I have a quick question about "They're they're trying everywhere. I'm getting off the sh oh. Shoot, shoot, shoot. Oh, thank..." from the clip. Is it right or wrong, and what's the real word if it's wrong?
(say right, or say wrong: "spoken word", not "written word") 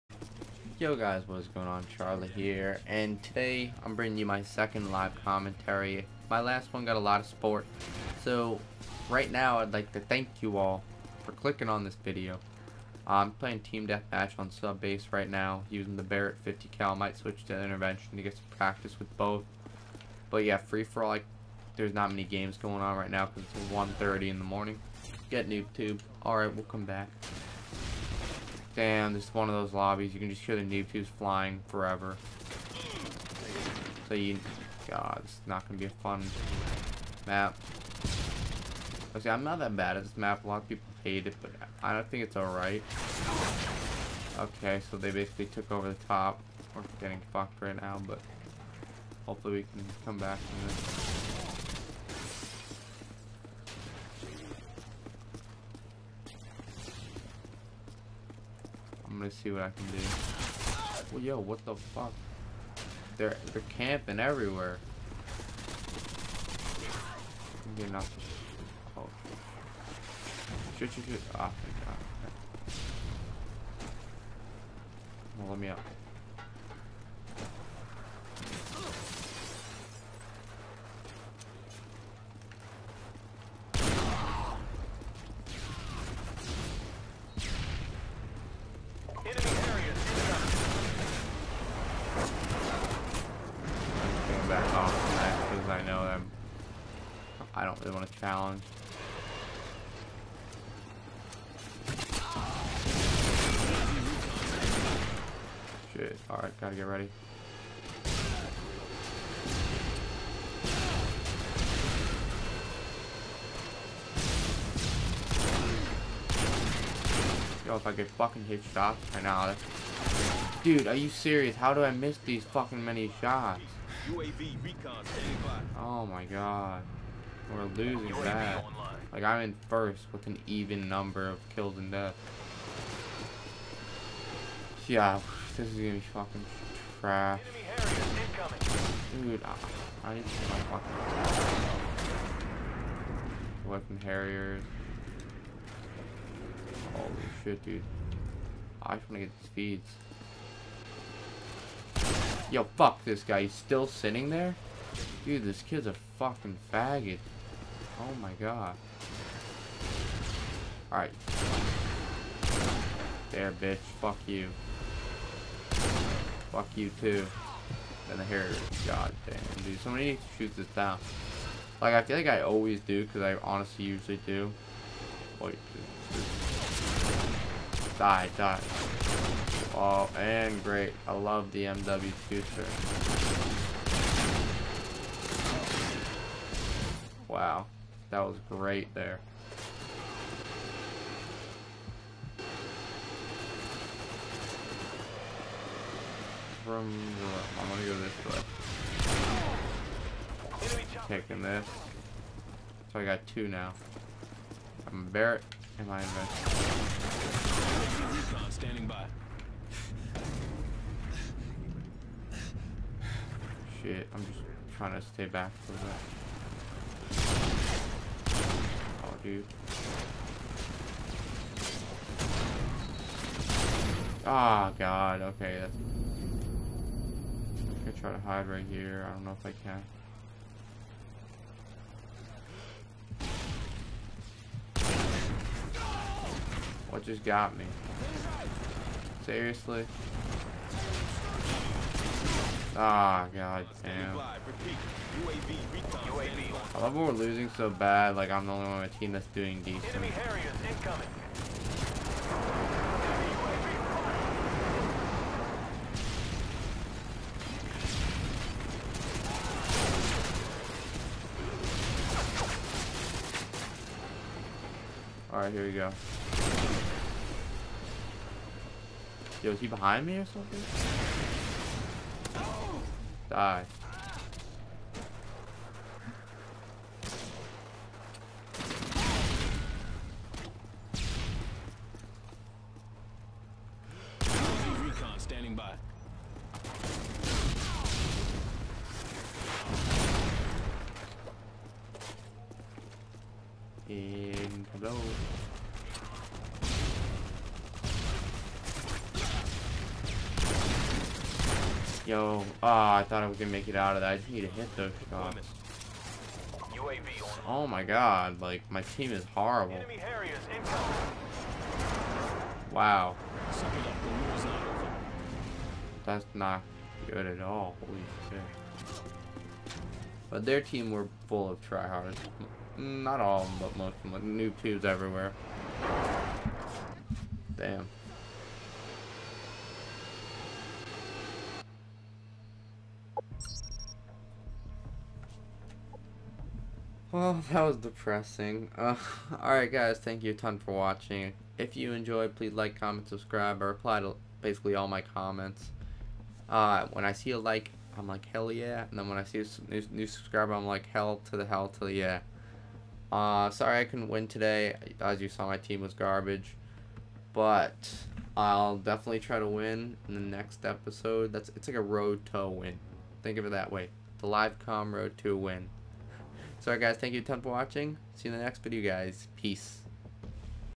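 wrong: "camping", not "trying".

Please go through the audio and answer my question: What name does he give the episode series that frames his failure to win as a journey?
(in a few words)
The live com road to a win.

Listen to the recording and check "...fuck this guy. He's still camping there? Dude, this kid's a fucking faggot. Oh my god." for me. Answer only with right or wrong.
wrong.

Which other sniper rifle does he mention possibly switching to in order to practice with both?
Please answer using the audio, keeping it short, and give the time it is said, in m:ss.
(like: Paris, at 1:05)
Intervention, at 0:17.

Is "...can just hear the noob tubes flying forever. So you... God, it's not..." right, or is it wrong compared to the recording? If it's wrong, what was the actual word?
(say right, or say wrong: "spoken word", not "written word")
right.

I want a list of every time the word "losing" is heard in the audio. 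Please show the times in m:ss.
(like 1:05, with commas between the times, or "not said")
2:07, 4:07.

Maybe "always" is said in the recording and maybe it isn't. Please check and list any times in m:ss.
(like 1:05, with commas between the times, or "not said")
2:52.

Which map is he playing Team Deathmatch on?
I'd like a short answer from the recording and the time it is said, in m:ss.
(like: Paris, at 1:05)
Sub Base, at 0:14.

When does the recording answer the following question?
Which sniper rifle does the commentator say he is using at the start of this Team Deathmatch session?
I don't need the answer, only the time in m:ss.
0:16.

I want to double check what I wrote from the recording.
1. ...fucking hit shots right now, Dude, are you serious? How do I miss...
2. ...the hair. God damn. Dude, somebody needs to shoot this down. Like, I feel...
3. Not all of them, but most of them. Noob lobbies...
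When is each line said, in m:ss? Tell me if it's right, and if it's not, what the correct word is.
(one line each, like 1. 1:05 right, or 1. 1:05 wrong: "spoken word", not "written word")
1. 1:58 right
2. 2:48 right
3. 5:22 wrong: "tubes", not "lobbies".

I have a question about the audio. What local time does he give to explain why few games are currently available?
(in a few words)
1:30 in the morning.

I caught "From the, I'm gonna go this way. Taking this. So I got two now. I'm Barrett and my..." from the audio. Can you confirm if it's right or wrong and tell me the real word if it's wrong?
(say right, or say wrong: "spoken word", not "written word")
right.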